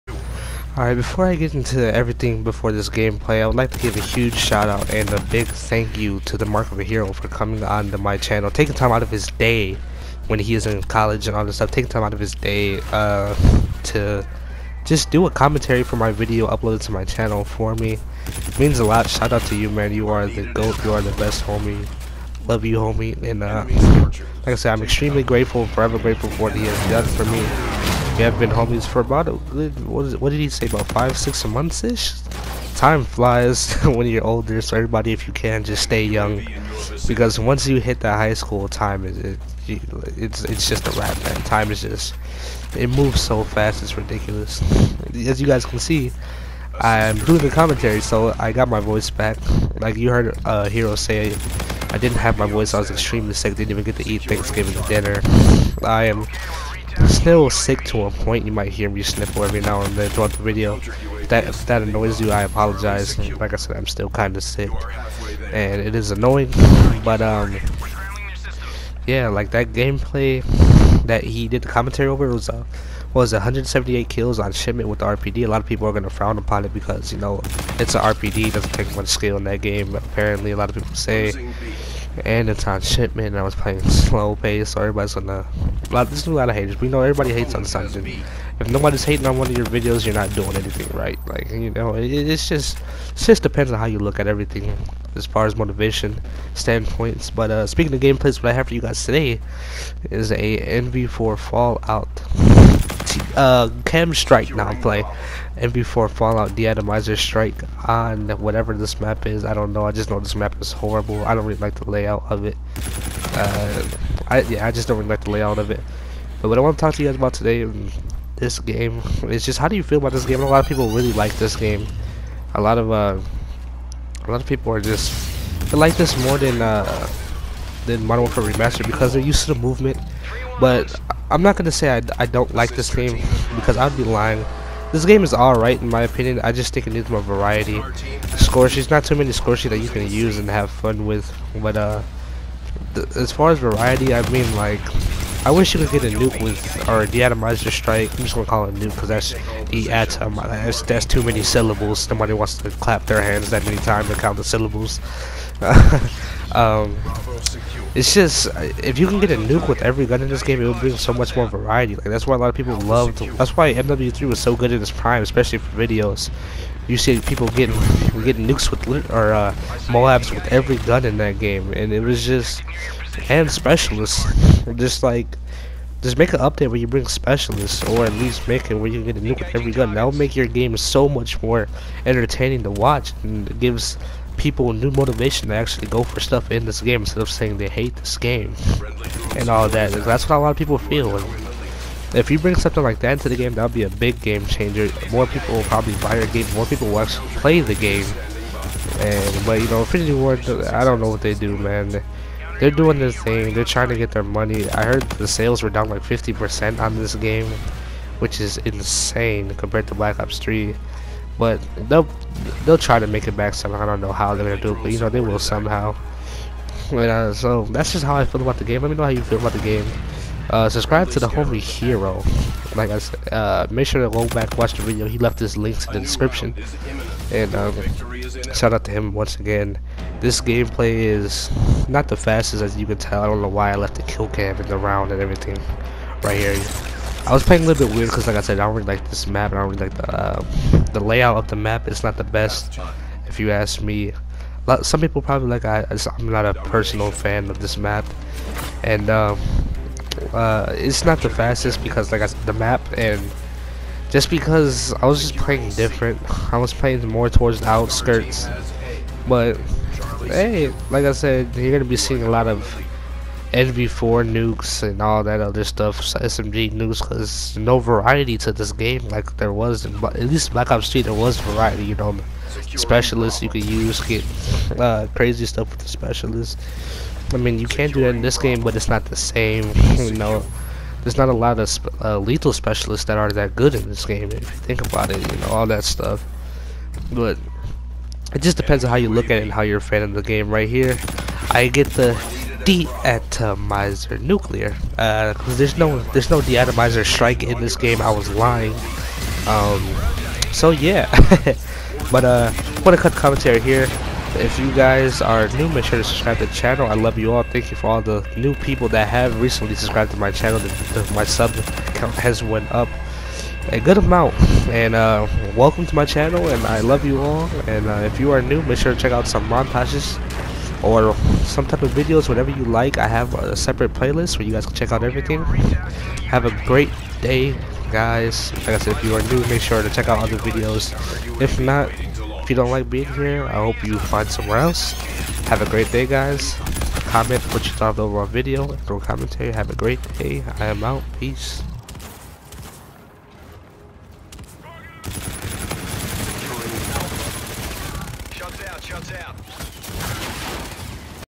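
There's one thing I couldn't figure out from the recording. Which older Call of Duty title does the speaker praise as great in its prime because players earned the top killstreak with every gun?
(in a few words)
MW3.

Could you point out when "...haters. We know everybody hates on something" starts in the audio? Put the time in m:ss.
1:26.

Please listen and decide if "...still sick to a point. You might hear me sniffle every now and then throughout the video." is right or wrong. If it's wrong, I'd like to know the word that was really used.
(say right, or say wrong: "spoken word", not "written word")
right.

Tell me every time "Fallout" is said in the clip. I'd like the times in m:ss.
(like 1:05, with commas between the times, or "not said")
1:41, 1:46.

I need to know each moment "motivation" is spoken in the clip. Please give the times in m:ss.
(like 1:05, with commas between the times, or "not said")
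1:35, 3:04.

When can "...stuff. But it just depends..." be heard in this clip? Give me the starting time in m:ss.
4:45.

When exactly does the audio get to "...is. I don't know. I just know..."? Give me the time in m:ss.
1:49.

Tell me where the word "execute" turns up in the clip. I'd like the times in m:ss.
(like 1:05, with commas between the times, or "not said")
not said.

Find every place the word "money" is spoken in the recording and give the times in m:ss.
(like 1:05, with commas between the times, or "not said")
3:24.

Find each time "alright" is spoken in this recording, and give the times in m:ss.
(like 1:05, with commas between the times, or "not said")
0:00, 2:15.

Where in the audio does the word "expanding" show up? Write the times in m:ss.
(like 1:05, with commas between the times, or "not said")
not said.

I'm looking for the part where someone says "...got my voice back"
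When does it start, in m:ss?
0:48.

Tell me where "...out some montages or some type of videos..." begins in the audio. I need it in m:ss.
5:19.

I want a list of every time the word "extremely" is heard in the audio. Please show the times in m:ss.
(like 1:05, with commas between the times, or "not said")
0:24, 0:52.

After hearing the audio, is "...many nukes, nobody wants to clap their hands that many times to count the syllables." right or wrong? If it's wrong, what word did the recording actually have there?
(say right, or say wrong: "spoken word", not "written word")
wrong: "syllables", not "nukes".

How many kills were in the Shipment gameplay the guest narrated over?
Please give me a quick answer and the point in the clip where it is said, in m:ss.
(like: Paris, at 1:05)
178, at 1:13.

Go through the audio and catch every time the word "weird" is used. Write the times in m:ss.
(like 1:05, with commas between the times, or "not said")
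3:57.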